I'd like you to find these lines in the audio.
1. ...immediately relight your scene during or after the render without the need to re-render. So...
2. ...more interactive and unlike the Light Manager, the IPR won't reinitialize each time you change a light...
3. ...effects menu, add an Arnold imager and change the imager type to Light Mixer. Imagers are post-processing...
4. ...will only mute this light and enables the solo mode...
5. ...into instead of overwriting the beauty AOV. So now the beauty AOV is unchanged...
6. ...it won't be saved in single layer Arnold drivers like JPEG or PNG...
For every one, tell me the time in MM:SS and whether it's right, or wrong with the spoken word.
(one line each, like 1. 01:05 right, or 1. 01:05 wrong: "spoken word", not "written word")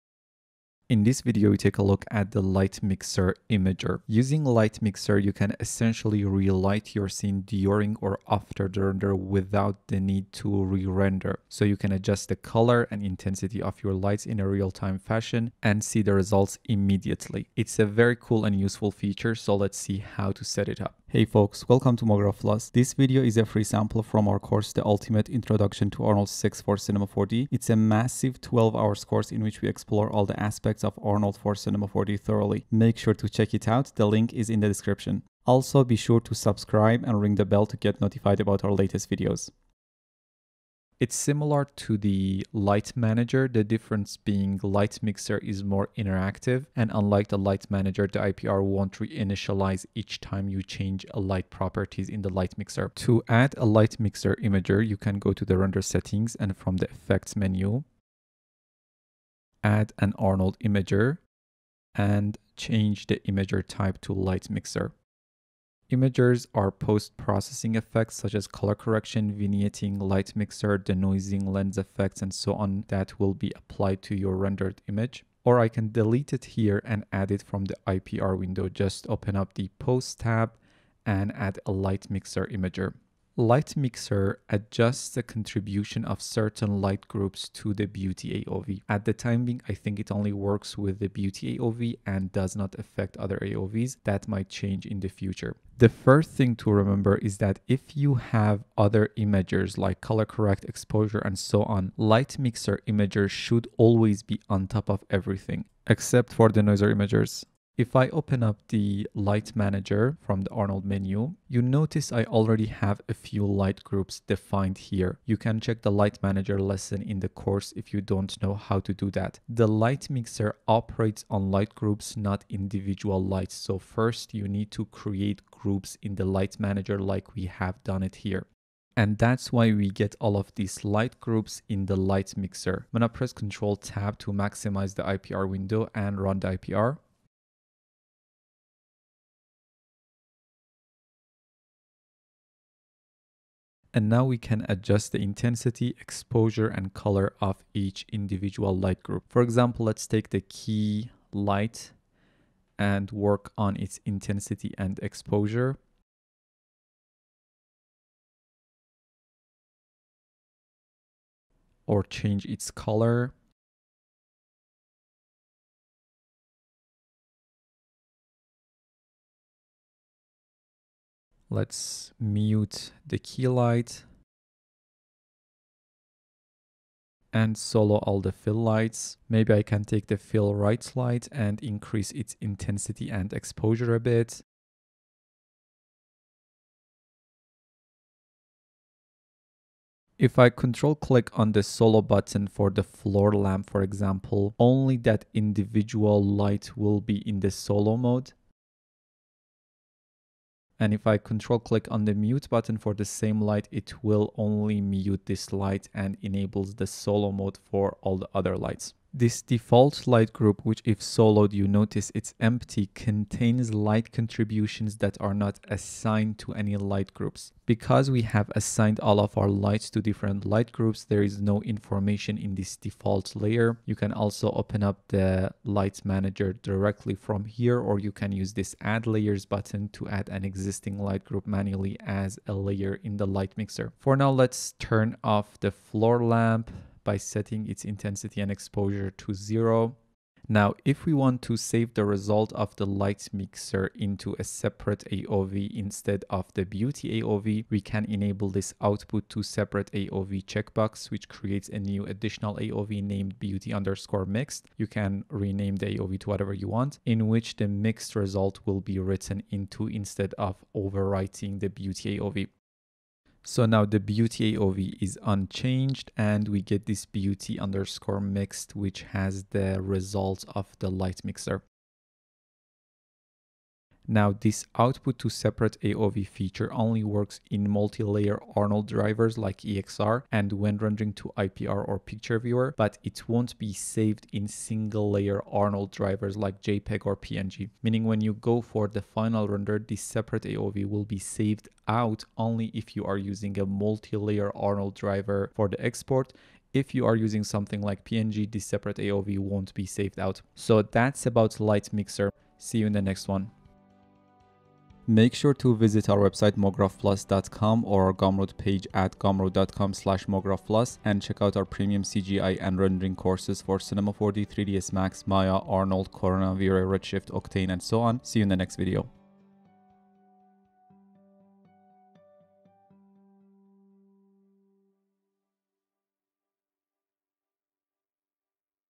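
1. 00:05 wrong: "essentially", not "immediately"
2. 00:45 right
3. 00:56 right
4. 03:24 right
5. 04:19 right
6. 04:43 right.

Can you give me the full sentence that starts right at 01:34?
That might change in the future.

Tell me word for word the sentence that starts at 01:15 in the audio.
Or I can delete it here and add it from the IPR window.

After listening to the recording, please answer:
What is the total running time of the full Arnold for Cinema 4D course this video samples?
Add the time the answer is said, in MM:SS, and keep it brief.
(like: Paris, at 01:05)
12 hours, at 00:28.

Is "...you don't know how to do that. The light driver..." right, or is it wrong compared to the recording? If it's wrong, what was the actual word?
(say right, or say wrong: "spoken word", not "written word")
wrong: "mixer", not "driver".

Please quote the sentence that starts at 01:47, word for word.
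If I open up the light manager from the Arnold menu, you notice I already have a few light groups defined here.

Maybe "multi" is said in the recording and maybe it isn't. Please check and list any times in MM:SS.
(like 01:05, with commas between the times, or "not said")
04:37, 04:53.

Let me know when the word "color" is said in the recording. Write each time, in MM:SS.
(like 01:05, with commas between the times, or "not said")
00:12, 01:08, 01:40, 02:26, 02:42.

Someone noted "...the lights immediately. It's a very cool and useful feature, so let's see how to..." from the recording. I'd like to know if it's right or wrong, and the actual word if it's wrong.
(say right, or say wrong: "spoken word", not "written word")
wrong: "results", not "lights".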